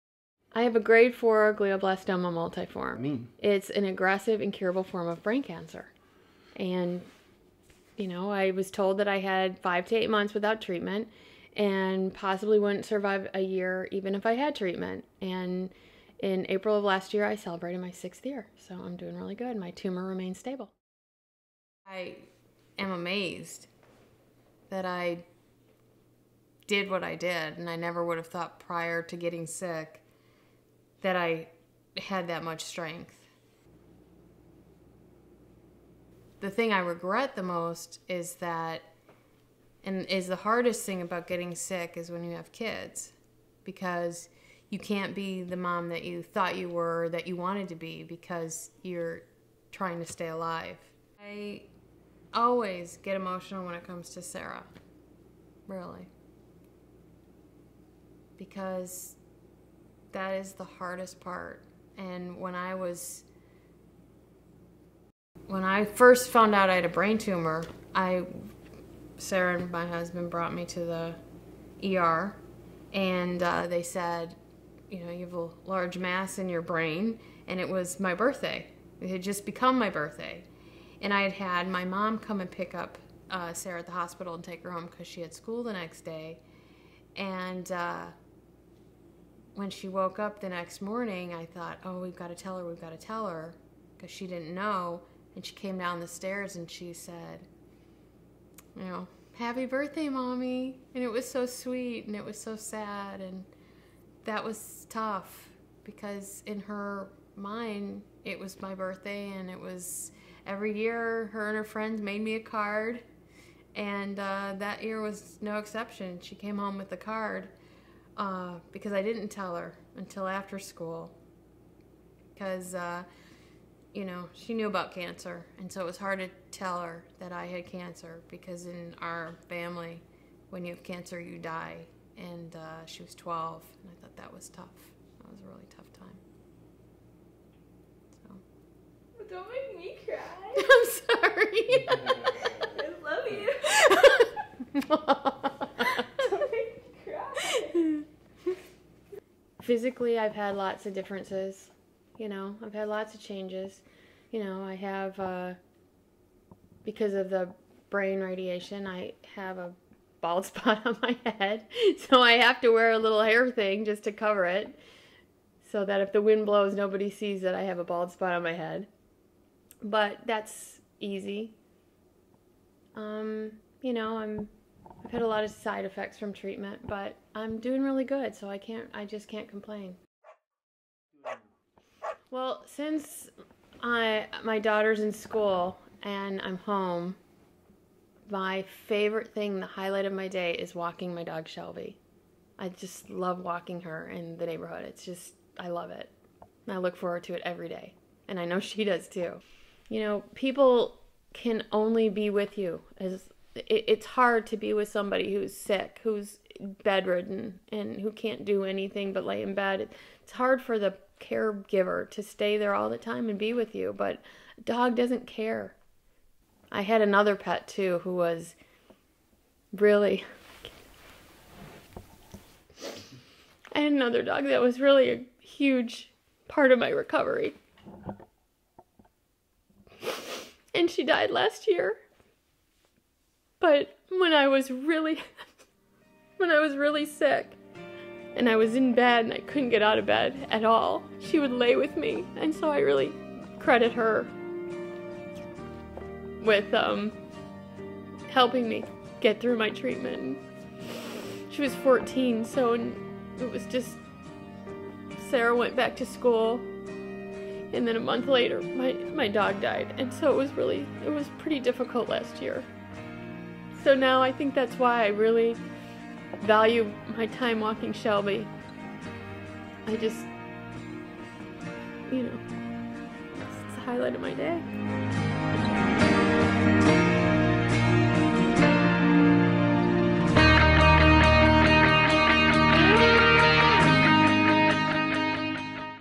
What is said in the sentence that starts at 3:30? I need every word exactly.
It's hard for the caregiver to stay there all the time and be with you, but a dog doesn't care.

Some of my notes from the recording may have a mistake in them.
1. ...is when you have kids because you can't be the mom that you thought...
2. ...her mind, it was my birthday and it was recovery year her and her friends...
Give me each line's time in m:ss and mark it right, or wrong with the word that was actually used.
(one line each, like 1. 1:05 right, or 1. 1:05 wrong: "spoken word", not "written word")
1. 0:41 right
2. 1:46 wrong: "every", not "recovery".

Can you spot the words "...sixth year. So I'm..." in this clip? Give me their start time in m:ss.
0:17.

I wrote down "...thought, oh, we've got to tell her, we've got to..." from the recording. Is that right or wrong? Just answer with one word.
right.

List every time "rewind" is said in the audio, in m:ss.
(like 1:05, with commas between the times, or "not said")
not said.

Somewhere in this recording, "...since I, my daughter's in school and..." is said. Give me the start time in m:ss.
3:02.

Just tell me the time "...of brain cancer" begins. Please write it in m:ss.
0:05.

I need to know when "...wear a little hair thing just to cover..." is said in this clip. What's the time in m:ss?
2:42.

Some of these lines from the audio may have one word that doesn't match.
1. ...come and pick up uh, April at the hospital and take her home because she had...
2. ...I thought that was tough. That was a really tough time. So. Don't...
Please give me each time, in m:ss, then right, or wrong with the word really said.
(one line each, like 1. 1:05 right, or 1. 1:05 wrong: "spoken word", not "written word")
1. 1:22 wrong: "Sarah", not "April"
2. 2:13 right.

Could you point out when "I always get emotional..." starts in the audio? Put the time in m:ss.
0:51.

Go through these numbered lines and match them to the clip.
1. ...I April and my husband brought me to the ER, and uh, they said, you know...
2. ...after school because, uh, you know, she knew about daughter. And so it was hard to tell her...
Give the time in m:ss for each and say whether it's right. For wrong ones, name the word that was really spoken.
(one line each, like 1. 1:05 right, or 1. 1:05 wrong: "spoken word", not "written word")
1. 1:07 wrong: "Sarah", not "April"
2. 2:00 wrong: "cancer", not "daughter".